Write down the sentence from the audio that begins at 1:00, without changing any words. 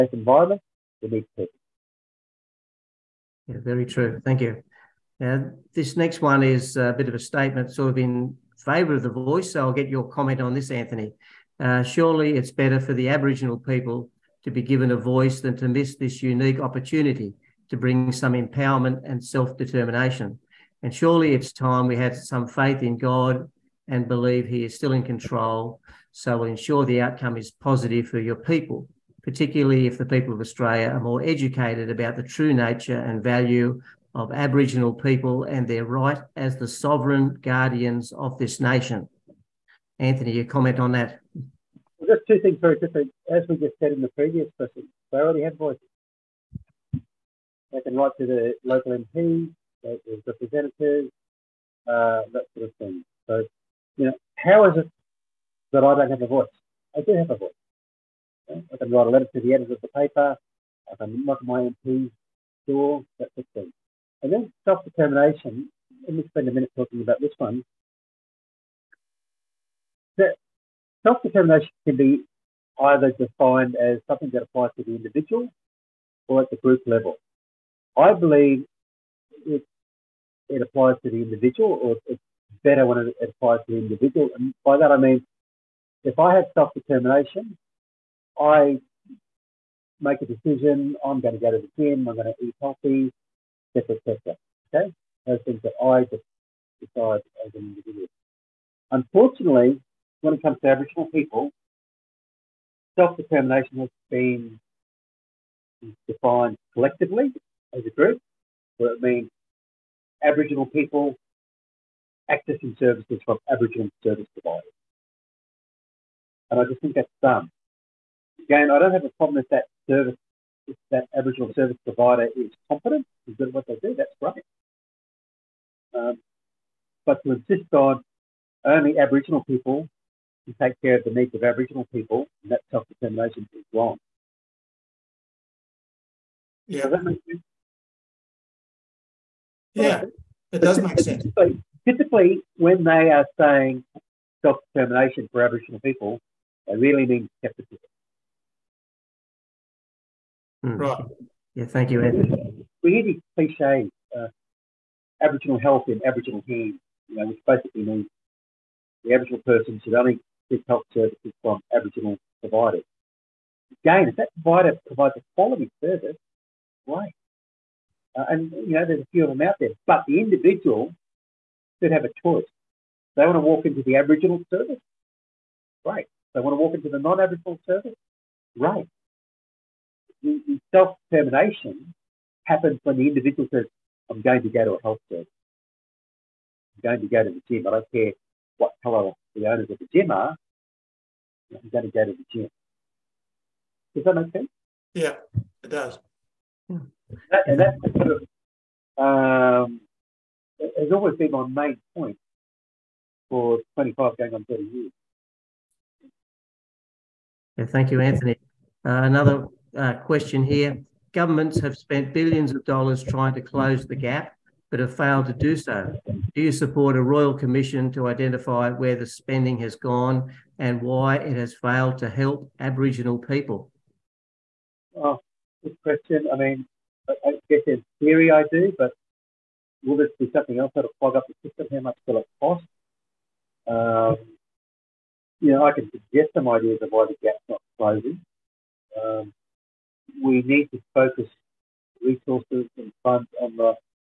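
I can knock my MP's door, That's sort thing.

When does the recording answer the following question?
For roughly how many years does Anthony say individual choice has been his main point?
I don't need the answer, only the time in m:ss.
3:23.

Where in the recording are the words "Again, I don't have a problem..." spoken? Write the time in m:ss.
1:58.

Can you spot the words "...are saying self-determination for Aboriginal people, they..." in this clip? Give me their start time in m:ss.
2:23.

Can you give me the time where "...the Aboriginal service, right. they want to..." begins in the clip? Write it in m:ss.
2:53.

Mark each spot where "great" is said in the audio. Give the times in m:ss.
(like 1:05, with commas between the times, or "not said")
2:04, 2:46.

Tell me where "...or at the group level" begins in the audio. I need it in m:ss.
1:16.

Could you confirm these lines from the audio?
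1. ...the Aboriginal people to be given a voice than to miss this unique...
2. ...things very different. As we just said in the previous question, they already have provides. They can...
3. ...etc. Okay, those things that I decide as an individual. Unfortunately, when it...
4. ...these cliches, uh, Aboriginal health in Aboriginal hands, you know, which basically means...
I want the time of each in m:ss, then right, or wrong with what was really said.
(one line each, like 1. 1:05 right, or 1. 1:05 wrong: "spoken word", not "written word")
1. 0:12 right
2. 0:42 wrong: "voices", not "provides"
3. 1:34 right
4. 2:33 right.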